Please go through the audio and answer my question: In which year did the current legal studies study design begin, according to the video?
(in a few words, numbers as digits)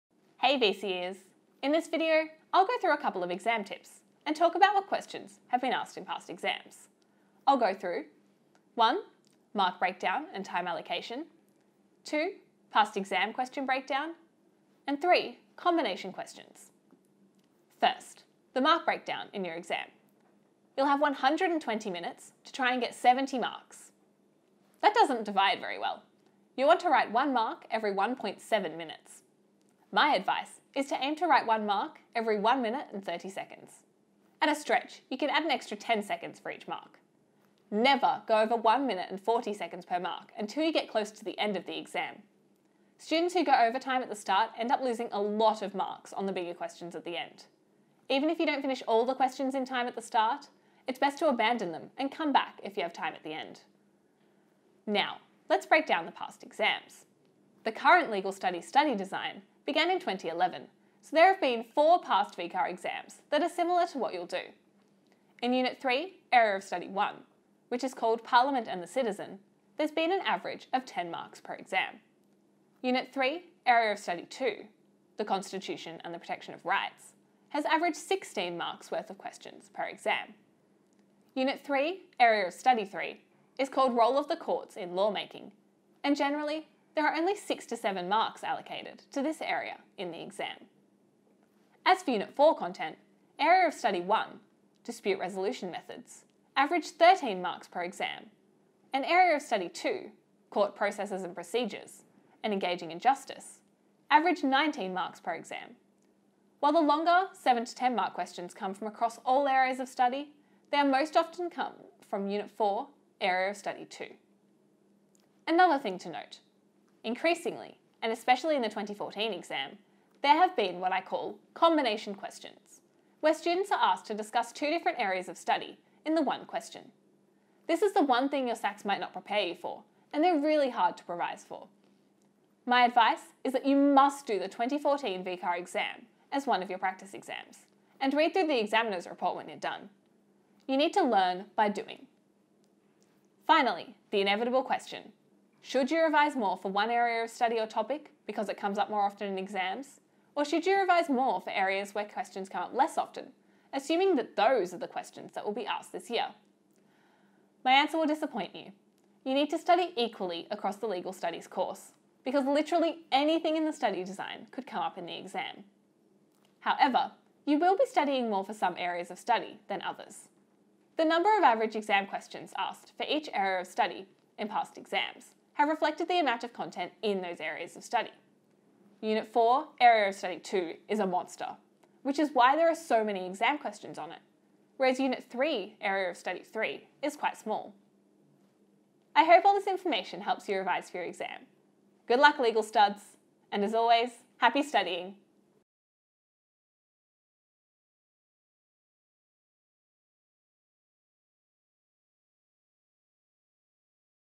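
2011.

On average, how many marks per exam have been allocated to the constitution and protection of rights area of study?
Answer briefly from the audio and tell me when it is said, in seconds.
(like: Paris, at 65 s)
16, at 77 s.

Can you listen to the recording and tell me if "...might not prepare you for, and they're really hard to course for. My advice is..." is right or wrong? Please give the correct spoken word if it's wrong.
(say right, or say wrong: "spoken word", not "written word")
wrong: "revise", not "course".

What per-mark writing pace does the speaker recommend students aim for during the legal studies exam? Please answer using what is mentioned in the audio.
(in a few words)
1 minute 30 seconds.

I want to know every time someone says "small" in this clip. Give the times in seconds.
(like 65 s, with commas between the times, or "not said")
187 s.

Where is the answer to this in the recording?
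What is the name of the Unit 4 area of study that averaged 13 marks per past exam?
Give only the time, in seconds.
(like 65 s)
94 s.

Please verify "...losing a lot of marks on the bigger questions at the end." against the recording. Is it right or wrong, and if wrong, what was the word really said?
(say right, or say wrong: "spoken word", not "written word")
right.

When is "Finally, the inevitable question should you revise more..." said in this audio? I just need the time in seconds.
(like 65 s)
143 s.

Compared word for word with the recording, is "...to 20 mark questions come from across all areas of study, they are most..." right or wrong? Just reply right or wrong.
wrong.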